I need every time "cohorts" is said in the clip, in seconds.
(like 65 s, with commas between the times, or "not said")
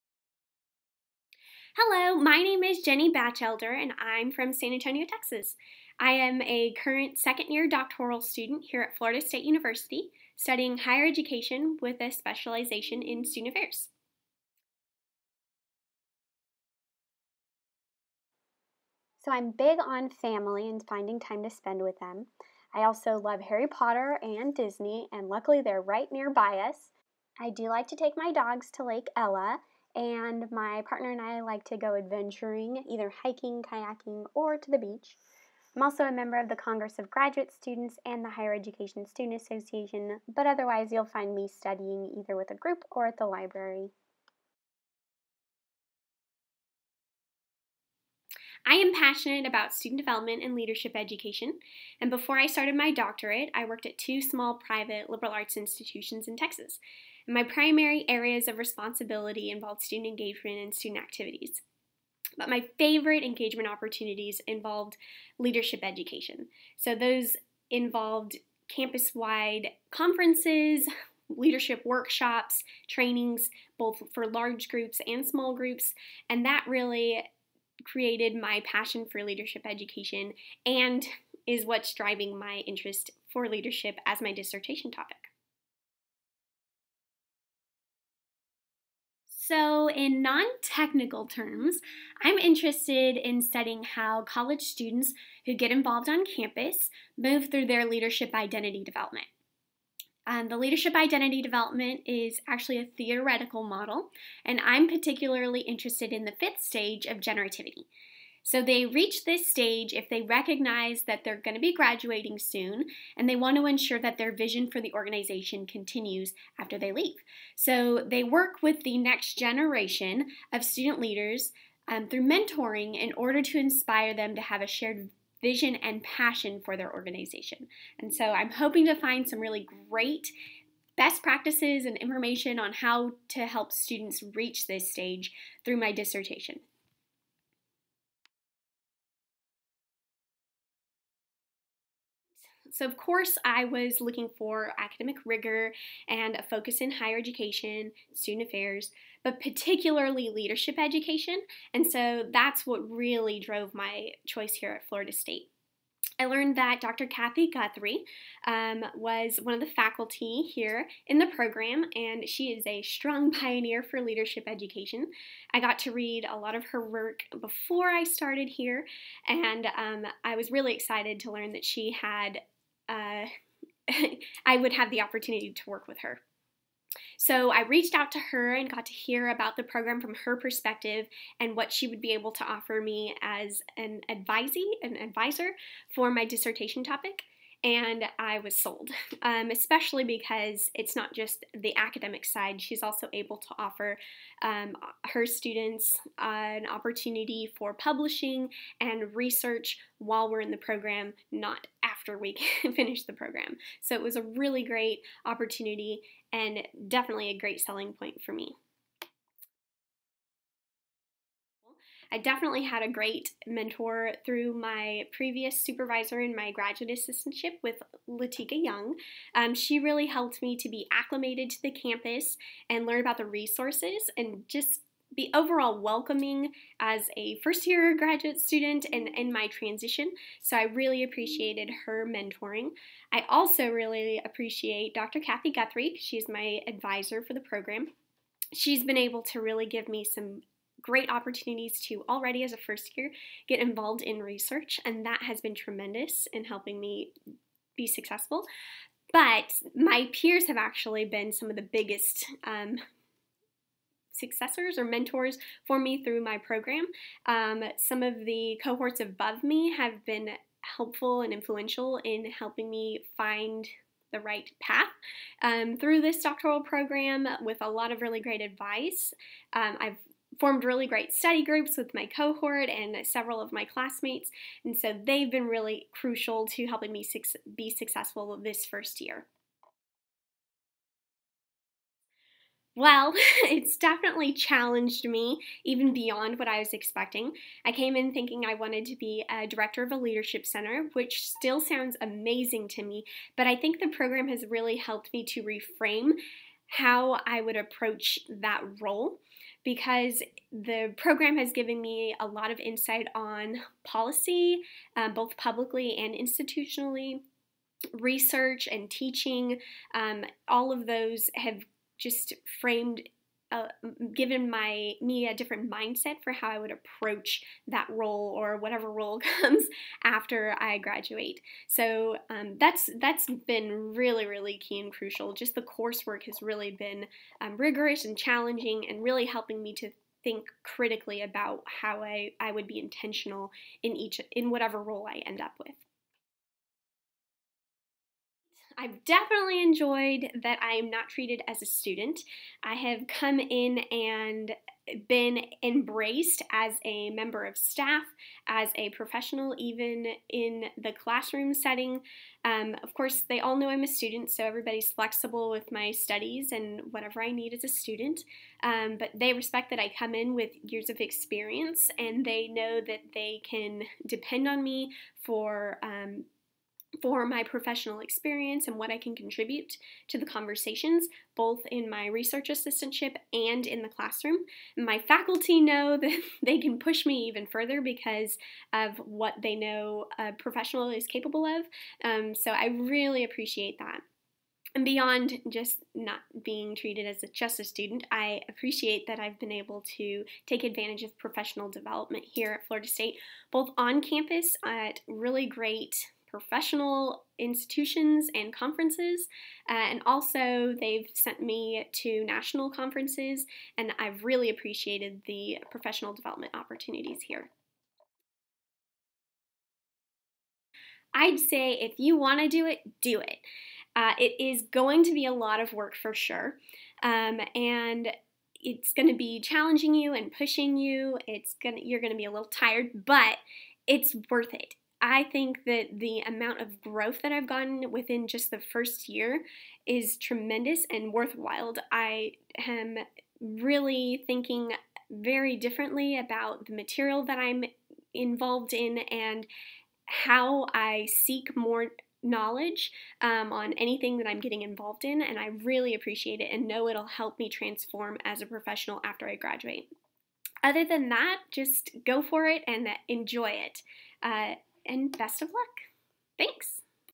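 258 s, 272 s.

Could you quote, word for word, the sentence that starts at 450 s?
Other than that, just go for it and enjoy it.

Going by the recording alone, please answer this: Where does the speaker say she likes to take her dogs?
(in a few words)
Lake Ella.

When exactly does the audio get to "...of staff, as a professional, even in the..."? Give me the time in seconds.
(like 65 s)
347 s.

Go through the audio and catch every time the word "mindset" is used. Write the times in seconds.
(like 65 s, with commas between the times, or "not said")
315 s.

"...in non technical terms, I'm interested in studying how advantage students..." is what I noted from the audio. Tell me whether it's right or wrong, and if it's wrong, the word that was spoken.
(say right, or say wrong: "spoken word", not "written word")
wrong: "college", not "advantage".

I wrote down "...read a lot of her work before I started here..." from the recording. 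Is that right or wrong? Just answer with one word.
right.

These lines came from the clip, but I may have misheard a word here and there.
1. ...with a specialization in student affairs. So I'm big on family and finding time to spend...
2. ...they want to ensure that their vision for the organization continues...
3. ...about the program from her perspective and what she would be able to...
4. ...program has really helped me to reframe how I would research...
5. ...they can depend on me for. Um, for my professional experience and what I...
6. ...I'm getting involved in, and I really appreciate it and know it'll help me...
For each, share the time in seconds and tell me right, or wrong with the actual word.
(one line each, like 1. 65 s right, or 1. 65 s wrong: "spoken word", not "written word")
1. 11 s right
2. 113 s right
3. 179 s right
4. 293 s wrong: "approach", not "research"
5. 363 s right
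6. 444 s right.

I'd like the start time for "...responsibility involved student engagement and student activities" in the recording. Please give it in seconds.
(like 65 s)
58 s.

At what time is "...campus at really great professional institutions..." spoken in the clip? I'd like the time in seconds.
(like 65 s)
394 s.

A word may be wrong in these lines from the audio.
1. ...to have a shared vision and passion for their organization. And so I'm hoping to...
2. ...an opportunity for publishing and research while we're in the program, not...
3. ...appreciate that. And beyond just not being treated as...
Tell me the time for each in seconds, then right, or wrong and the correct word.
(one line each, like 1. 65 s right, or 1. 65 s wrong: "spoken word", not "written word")
1. 124 s right
2. 196 s right
3. 383 s right.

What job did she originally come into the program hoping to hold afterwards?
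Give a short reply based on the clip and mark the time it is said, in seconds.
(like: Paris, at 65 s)
director of a leadership center, at 289 s.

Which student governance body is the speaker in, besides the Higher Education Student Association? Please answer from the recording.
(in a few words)
Congress of Graduate Students.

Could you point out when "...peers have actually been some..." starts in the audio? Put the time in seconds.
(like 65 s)
250 s.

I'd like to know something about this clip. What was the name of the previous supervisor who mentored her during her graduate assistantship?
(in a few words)
Latika Young.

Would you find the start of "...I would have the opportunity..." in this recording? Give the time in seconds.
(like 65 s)
174 s.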